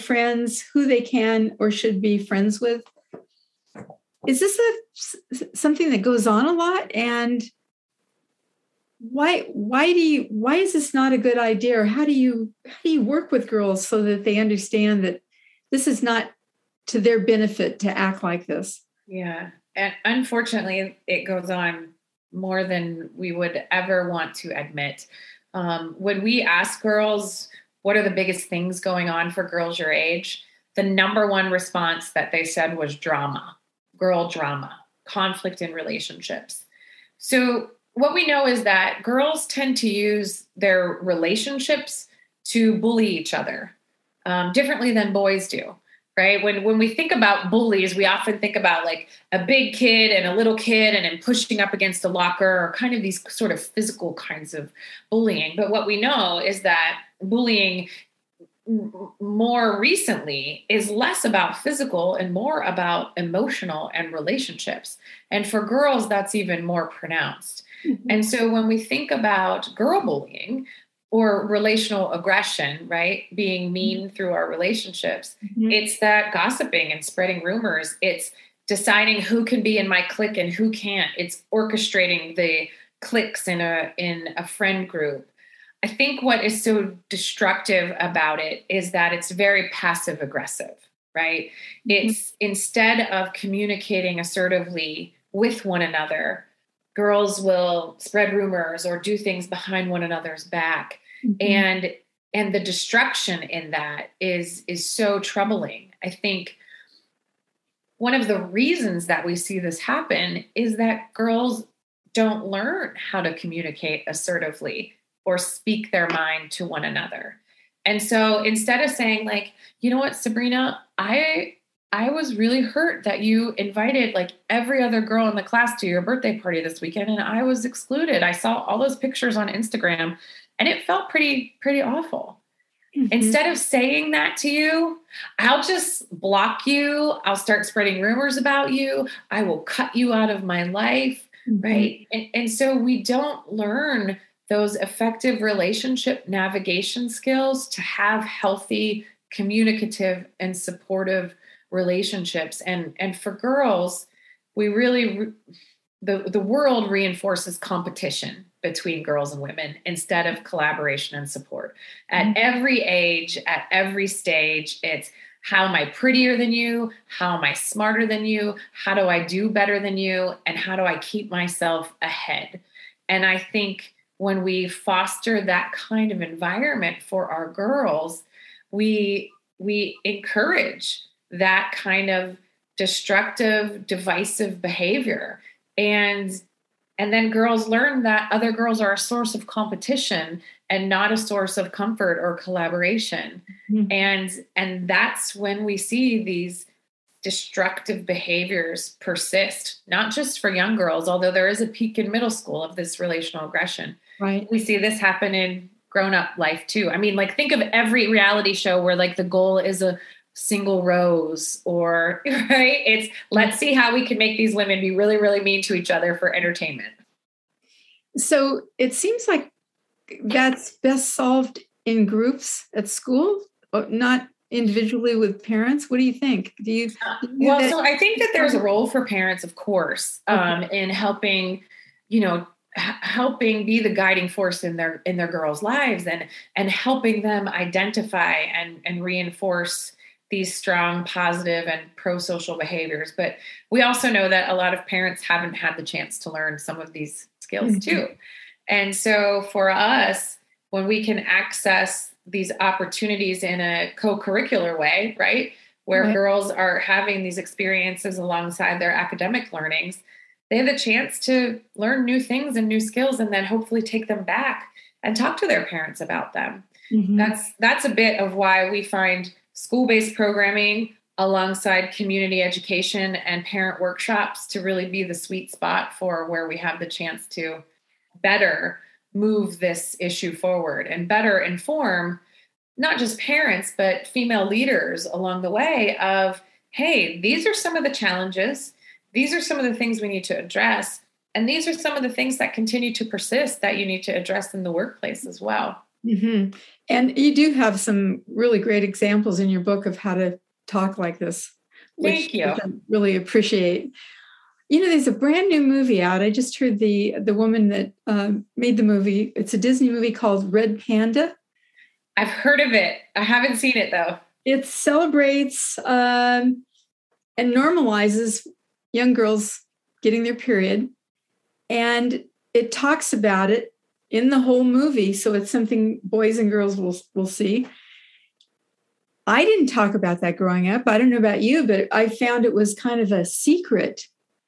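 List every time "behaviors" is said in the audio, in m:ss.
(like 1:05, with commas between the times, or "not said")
3:04, 3:18, 4:02.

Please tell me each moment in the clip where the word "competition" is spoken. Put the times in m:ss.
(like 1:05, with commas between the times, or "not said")
2:37, 3:09.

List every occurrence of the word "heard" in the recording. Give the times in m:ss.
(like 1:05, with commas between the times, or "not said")
5:06, 5:12.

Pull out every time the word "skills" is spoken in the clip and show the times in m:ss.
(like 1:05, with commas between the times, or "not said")
2:27, 4:07, 4:22.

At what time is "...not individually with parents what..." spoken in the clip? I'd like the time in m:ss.
3:43.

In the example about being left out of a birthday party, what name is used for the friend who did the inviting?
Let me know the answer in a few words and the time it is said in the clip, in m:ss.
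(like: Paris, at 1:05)
Sabrina, at 2:00.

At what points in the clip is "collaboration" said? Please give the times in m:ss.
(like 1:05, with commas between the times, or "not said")
2:40, 3:12.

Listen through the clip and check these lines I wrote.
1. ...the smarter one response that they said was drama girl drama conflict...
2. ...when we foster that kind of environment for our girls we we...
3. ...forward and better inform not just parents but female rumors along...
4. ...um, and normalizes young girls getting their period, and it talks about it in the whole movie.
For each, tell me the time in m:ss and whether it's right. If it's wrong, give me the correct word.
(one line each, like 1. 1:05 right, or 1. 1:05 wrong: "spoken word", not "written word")
1. 0:30 wrong: "number", not "smarter"
2. 2:54 right
3. 4:40 wrong: "leaders", not "rumors"
4. 5:15 right.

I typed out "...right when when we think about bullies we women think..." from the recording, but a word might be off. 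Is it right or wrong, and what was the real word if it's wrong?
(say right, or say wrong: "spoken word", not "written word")
wrong: "often", not "women".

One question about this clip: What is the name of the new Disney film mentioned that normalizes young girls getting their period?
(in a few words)
Red Panda.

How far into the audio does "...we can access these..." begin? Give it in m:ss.
4:10.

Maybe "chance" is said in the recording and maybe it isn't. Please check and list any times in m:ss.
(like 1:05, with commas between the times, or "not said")
4:05, 4:20, 4:36.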